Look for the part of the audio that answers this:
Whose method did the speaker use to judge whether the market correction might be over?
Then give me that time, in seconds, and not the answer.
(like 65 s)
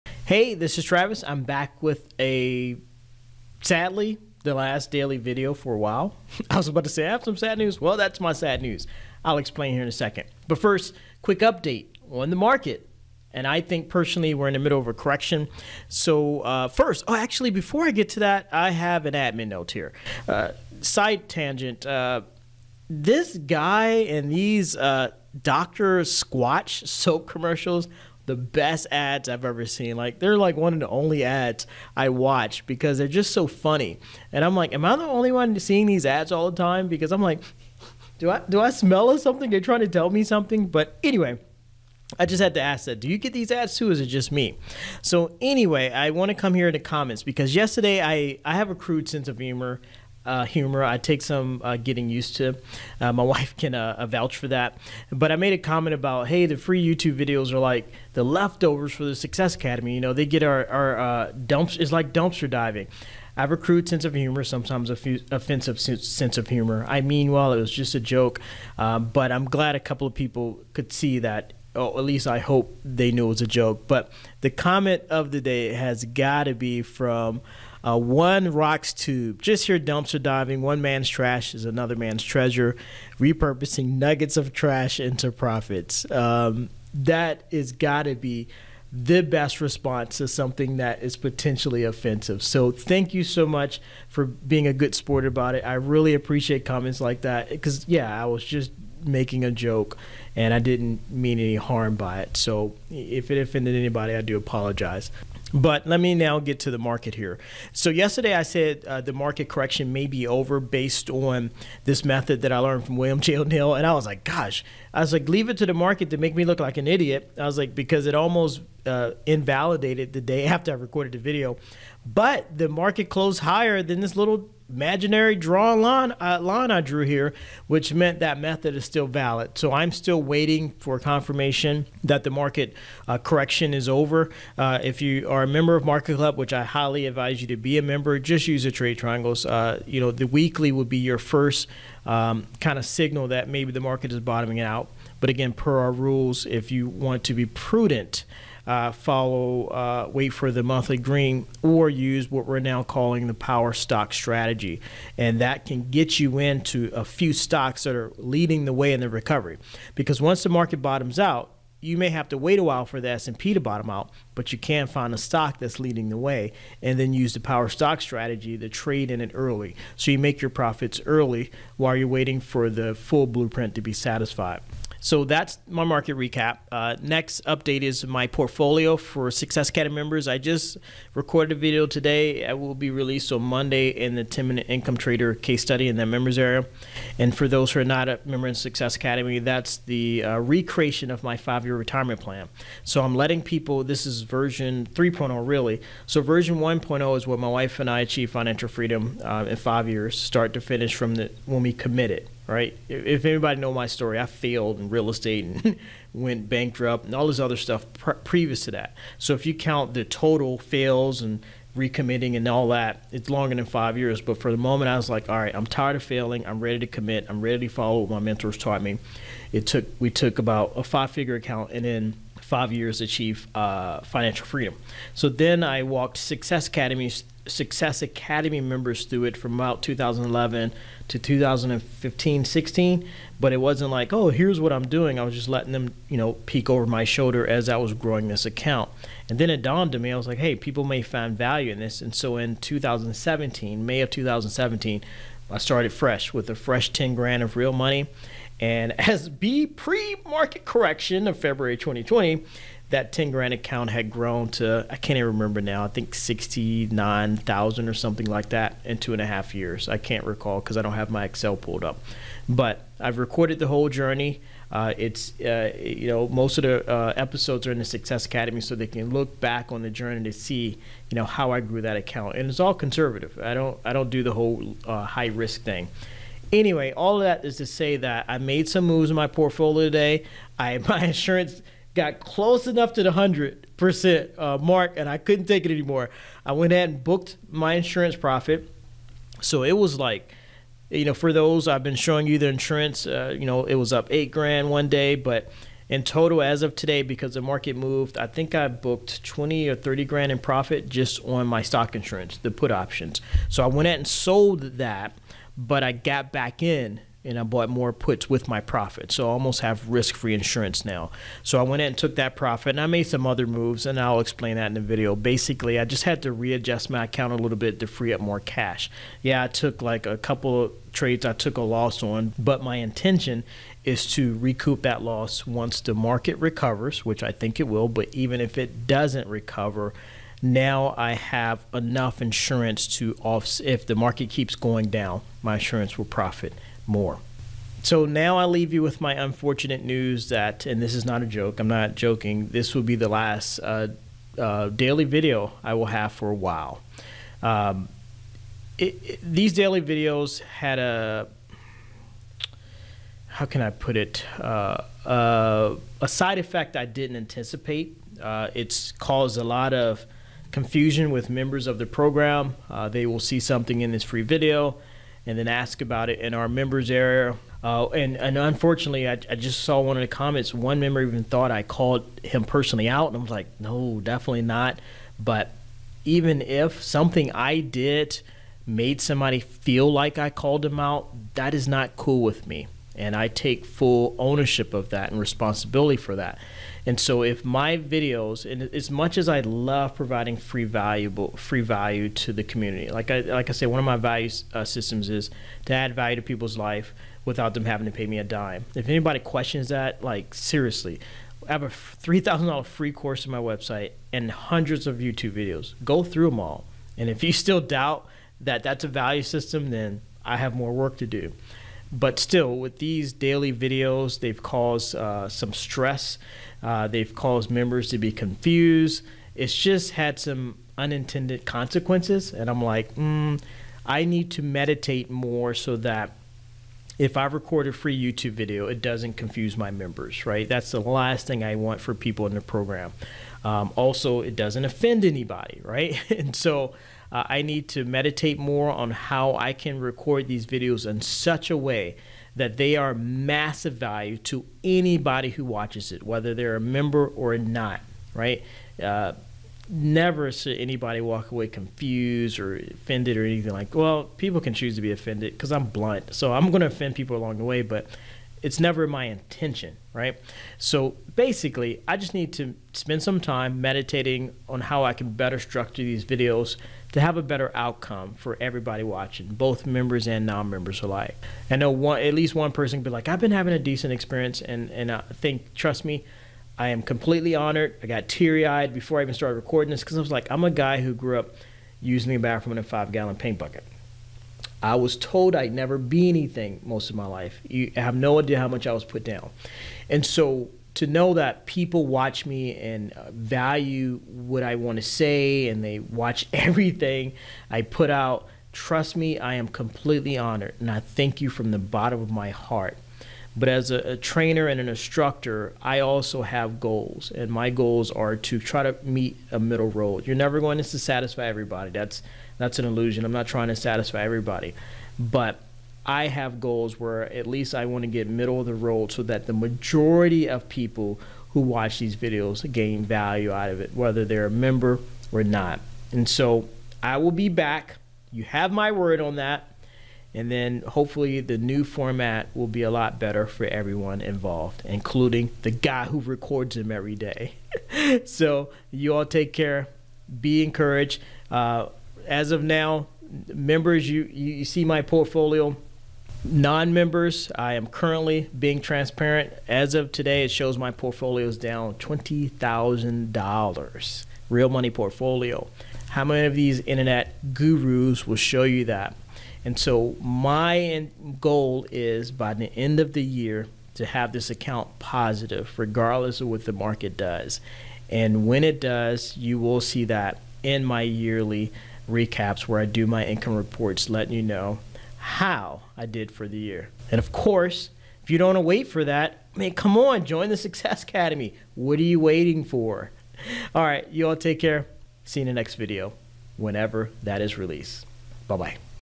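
112 s.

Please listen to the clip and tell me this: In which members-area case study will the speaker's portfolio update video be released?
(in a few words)
10 minute income trader.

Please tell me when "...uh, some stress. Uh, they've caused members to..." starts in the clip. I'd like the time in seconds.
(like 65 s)
414 s.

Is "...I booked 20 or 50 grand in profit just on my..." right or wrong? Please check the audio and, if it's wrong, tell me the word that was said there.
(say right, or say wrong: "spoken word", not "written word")
wrong: "30", not "50".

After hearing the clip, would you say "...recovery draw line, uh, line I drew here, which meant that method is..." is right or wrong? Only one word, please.
wrong.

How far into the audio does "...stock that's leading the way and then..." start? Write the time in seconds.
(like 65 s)
165 s.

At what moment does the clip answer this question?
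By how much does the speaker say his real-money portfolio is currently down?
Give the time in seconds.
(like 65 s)
551 s.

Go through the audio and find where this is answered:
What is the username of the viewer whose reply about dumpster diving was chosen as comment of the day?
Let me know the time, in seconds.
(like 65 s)
77 s.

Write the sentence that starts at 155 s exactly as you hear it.
And that can get you into a few stocks that are leading the way in the recovery.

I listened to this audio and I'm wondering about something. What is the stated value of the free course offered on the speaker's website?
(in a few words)
$3,000.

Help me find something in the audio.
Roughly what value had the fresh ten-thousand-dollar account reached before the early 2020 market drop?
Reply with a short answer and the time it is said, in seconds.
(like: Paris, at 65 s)
69,000, at 256 s.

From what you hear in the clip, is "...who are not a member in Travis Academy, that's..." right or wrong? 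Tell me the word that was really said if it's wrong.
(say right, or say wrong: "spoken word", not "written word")
wrong: "Success", not "Travis".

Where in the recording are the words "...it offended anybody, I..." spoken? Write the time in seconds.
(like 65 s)
103 s.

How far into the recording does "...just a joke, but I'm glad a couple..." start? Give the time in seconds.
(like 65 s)
67 s.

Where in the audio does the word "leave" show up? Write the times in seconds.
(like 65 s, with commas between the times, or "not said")
115 s, 338 s.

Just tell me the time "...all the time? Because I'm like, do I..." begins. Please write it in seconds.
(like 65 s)
36 s.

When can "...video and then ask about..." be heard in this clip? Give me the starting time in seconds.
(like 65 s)
364 s.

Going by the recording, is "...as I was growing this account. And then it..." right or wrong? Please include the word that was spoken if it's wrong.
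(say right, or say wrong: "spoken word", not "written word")
right.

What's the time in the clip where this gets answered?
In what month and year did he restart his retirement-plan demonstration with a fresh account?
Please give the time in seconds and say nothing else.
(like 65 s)
243 s.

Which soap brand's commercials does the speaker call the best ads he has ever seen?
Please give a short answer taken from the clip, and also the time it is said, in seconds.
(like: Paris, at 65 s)
Doctor Squatch, at 25 s.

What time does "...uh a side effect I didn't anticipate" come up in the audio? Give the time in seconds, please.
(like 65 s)
355 s.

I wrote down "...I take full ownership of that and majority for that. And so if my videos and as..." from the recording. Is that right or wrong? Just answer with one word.
wrong.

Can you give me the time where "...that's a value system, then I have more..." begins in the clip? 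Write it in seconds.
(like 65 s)
408 s.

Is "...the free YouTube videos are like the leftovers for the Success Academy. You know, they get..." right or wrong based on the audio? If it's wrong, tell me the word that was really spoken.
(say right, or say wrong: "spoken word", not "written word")
right.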